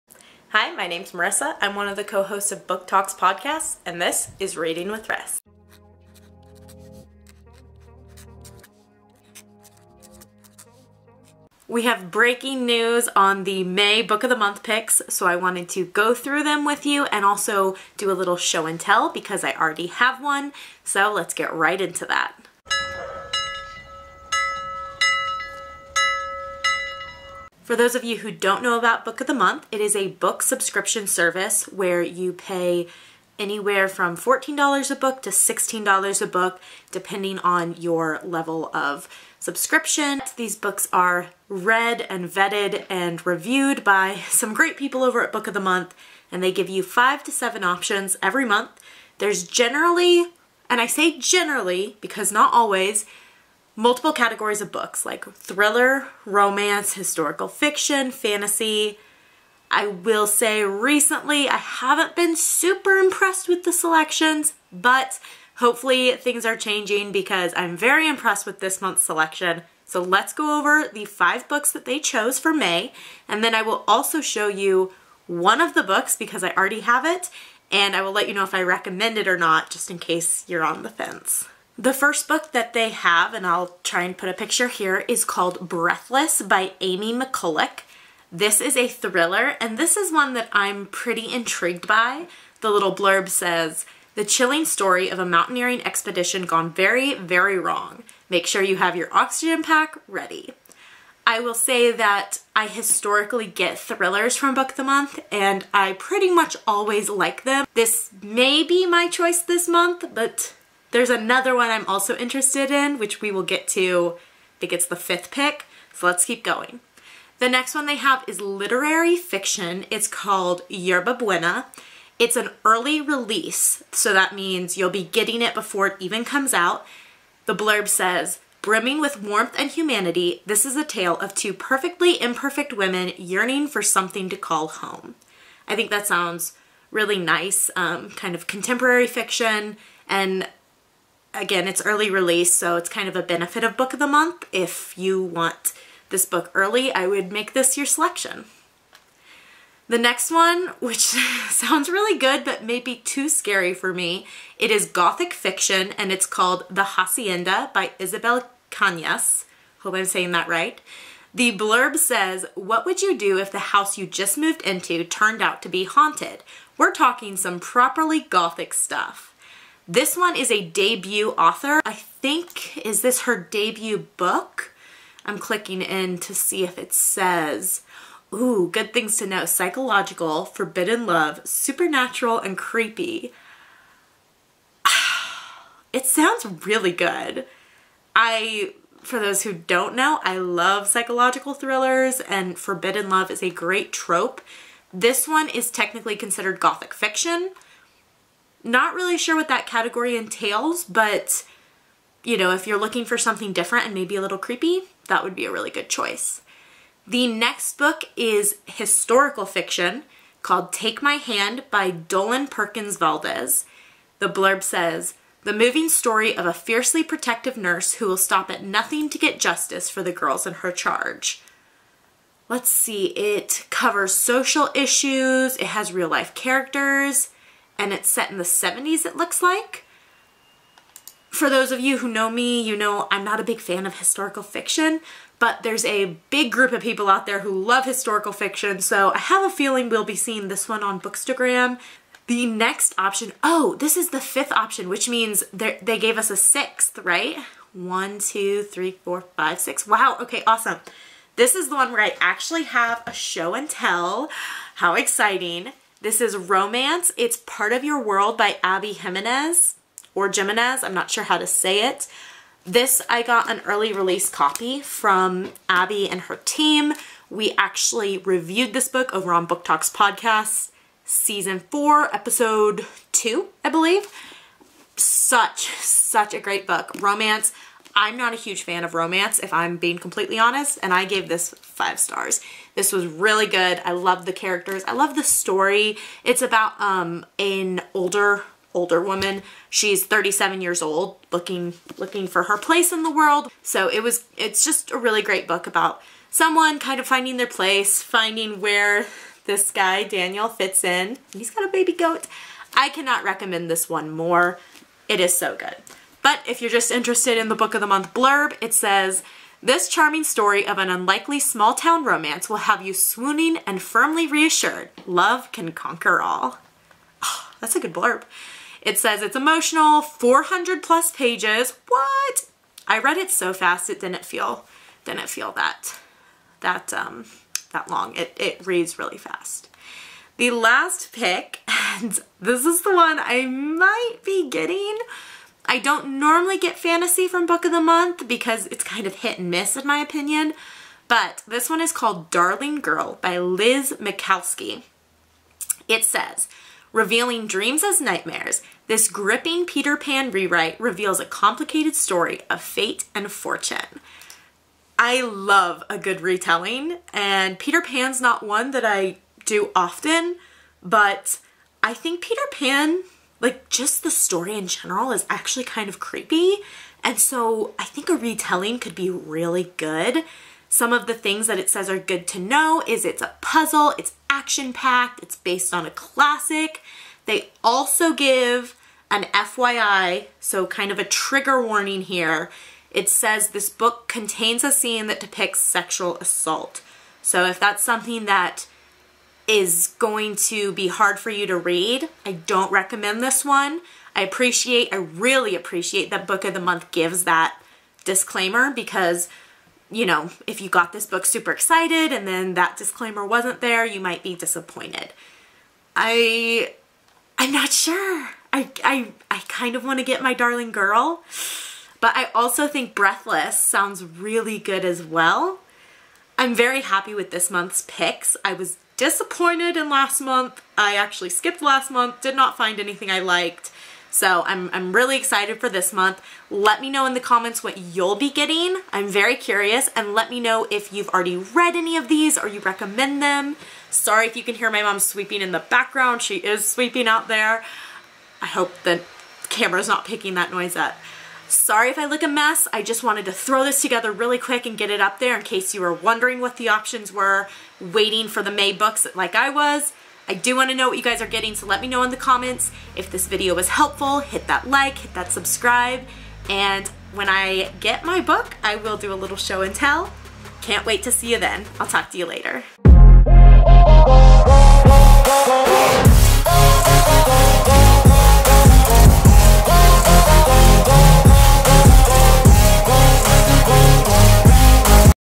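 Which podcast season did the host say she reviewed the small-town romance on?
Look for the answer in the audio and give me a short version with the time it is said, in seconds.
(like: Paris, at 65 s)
Season 4, at 271 s.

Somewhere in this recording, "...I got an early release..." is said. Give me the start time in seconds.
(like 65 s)
263 s.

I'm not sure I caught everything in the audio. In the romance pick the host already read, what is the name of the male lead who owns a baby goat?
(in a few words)
Daniel.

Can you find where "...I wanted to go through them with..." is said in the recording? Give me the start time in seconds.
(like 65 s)
15 s.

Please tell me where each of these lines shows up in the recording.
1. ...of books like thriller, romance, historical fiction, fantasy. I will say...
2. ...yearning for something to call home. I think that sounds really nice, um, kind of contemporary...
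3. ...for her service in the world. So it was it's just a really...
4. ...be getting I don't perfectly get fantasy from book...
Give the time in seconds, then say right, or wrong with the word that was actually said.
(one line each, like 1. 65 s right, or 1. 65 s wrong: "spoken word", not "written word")
1. 54 s right
2. 133 s right
3. 292 s wrong: "place", not "service"
4. 334 s wrong: "normally", not "perfectly".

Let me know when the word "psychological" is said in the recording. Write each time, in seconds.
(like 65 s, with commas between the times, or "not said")
179 s, 190 s.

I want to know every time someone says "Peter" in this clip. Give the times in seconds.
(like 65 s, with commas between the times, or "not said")
349 s, 357 s, 362 s.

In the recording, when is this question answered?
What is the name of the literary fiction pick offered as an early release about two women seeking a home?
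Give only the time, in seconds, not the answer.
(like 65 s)
120 s.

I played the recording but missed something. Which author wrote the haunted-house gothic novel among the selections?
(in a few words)
Isabel Cañas.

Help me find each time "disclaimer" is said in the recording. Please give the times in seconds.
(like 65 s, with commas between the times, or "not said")
398 s, 402 s.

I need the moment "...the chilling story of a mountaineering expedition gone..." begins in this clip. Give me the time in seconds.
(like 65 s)
94 s.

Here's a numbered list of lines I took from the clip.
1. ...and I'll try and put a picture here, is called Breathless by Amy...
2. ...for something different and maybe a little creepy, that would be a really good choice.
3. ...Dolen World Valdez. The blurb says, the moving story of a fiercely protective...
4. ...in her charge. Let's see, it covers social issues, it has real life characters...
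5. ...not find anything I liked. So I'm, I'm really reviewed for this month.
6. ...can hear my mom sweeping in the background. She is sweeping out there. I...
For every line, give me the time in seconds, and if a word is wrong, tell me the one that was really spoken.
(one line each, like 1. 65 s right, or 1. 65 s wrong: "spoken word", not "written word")
1. 83 s right
2. 203 s right
3. 211 s wrong: "Perkins", not "World"
4. 220 s right
5. 422 s wrong: "excited", not "reviewed"
6. 434 s right.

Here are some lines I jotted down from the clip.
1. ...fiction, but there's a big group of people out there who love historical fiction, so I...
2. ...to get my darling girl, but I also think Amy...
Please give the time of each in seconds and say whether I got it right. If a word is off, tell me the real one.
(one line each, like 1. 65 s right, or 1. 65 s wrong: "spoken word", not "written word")
1. 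234 s right
2. 409 s wrong: "Breathless", not "Amy".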